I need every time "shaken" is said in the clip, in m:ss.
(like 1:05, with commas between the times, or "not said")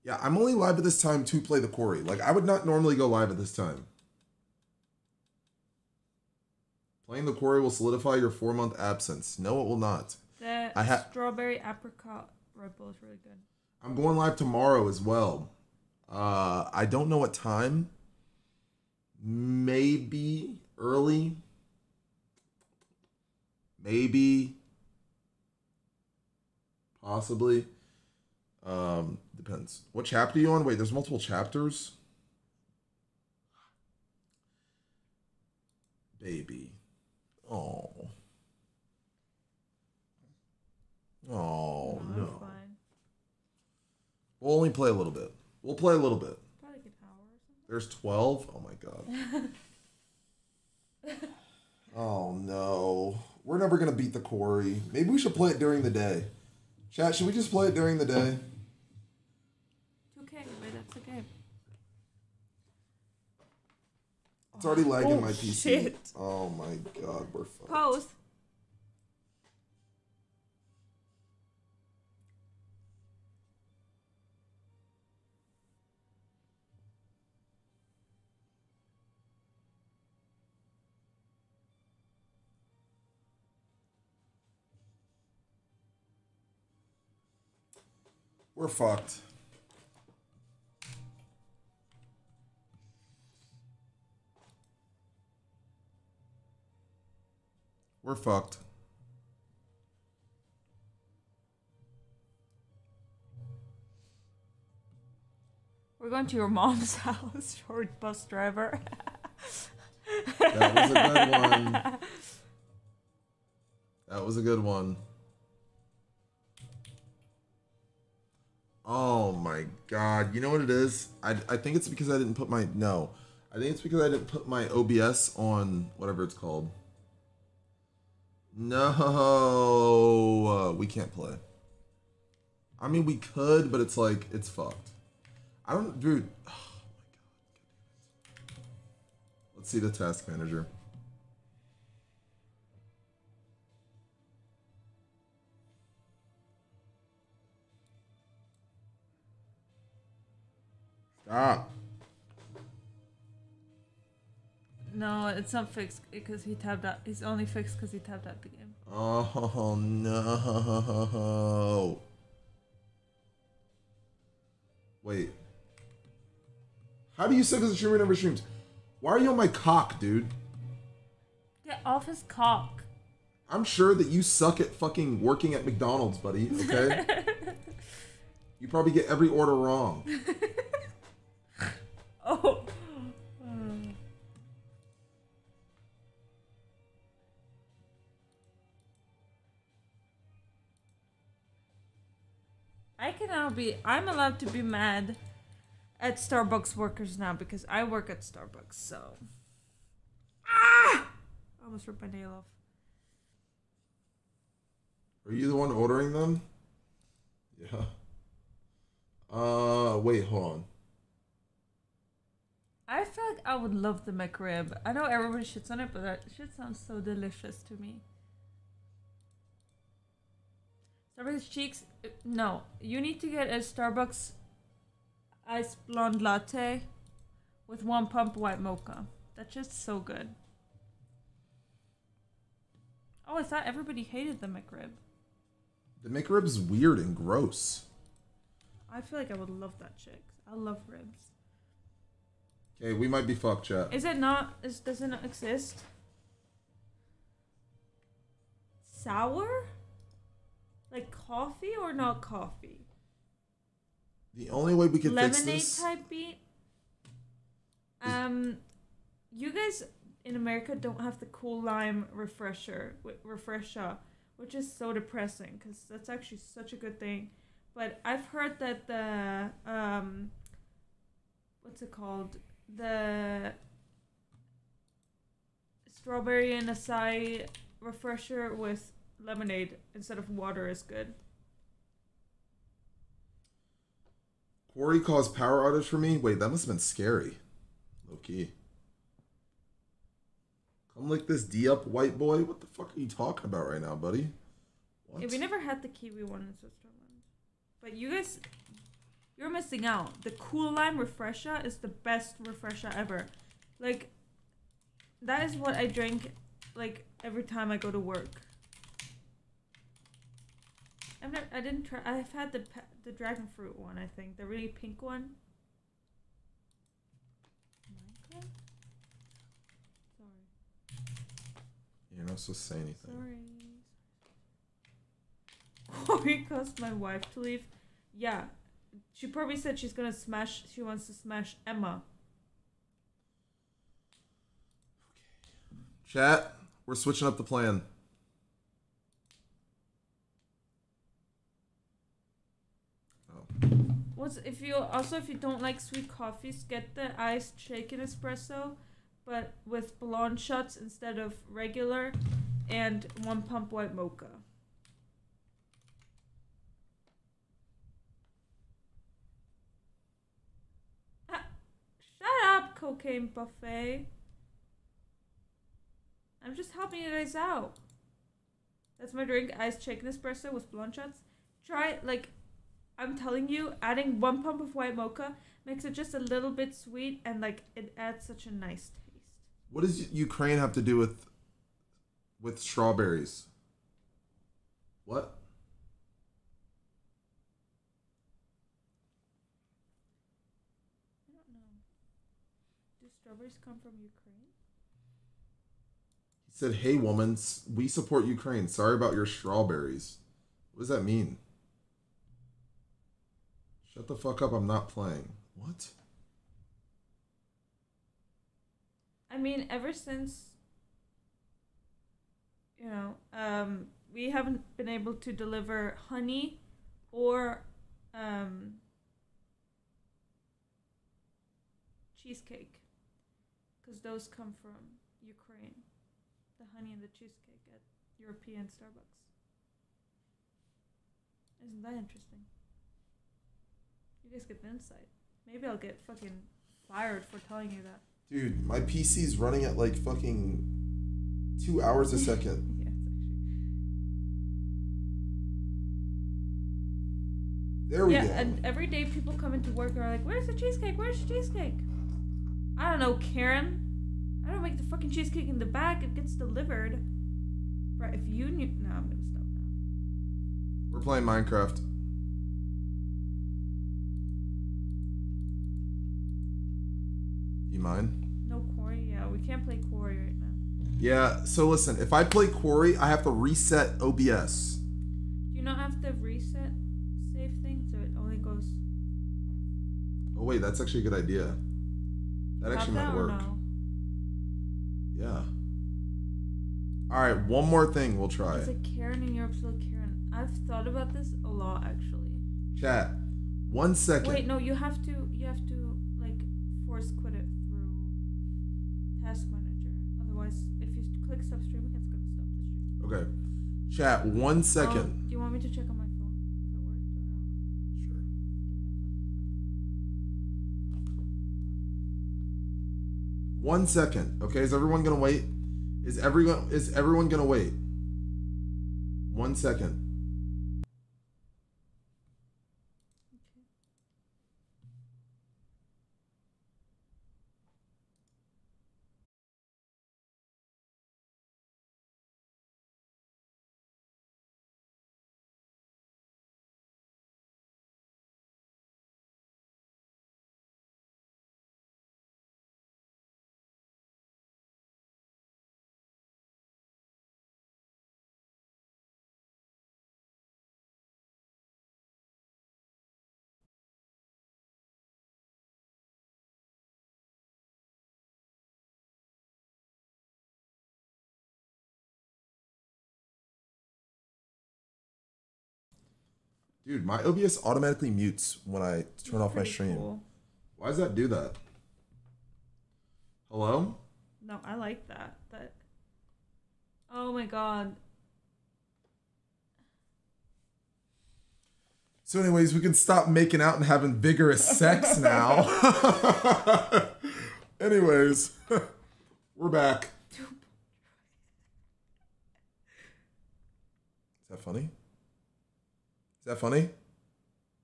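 5:47, 6:09.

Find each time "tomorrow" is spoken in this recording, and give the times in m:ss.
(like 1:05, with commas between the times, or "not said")
0:14.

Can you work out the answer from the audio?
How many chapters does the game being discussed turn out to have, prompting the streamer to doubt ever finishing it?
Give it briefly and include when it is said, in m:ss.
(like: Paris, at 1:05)
12, at 0:47.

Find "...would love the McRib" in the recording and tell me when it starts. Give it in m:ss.
3:33.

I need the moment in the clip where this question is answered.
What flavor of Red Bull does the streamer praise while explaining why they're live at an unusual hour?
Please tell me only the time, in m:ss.
0:11.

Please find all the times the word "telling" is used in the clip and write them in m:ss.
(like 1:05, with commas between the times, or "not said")
6:13, 7:17.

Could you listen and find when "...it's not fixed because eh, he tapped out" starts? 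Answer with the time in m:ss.
2:35.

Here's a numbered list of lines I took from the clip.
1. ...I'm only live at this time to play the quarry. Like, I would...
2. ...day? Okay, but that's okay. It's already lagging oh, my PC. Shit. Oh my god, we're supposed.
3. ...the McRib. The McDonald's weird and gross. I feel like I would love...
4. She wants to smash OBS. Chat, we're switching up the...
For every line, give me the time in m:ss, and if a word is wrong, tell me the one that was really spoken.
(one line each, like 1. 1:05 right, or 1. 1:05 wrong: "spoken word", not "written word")
1. 0:00 right
2. 0:58 wrong: "fucked", not "supposed"
3. 3:54 wrong: "McRib", not "McDonald"
4. 5:30 wrong: "Emma", not "OBS".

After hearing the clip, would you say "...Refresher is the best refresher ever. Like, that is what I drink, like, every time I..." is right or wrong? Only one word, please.
right.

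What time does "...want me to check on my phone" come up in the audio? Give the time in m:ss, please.
8:25.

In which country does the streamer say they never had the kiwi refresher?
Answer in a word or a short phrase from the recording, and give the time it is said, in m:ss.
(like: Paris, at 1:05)
Switzerland, at 4:56.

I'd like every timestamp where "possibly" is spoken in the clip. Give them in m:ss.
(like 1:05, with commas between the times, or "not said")
0:27.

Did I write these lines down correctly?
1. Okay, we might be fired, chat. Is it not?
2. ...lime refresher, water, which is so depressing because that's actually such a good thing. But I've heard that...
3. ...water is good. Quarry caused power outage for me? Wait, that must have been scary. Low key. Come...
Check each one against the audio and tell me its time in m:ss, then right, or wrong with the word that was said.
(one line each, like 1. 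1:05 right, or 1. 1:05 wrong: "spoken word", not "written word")
1. 4:02 wrong: "fucked", not "fired"
2. 4:21 wrong: "refresher", not "water"
3. 4:40 right.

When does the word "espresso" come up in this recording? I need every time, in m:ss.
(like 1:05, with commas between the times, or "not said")
5:48, 6:10.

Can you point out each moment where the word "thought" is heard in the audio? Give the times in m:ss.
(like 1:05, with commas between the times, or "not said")
3:53, 8:10.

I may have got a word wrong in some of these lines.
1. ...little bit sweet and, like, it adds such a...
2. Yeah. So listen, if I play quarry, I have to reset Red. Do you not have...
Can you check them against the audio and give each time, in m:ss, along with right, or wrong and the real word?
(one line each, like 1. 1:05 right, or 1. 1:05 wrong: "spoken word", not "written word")
1. 6:16 right
2. 7:50 wrong: "OBS", not "Red".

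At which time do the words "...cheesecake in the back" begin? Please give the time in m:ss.
7:35.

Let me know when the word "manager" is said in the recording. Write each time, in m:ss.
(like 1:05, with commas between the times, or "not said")
2:20, 8:19.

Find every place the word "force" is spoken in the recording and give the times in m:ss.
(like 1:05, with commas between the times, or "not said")
8:16.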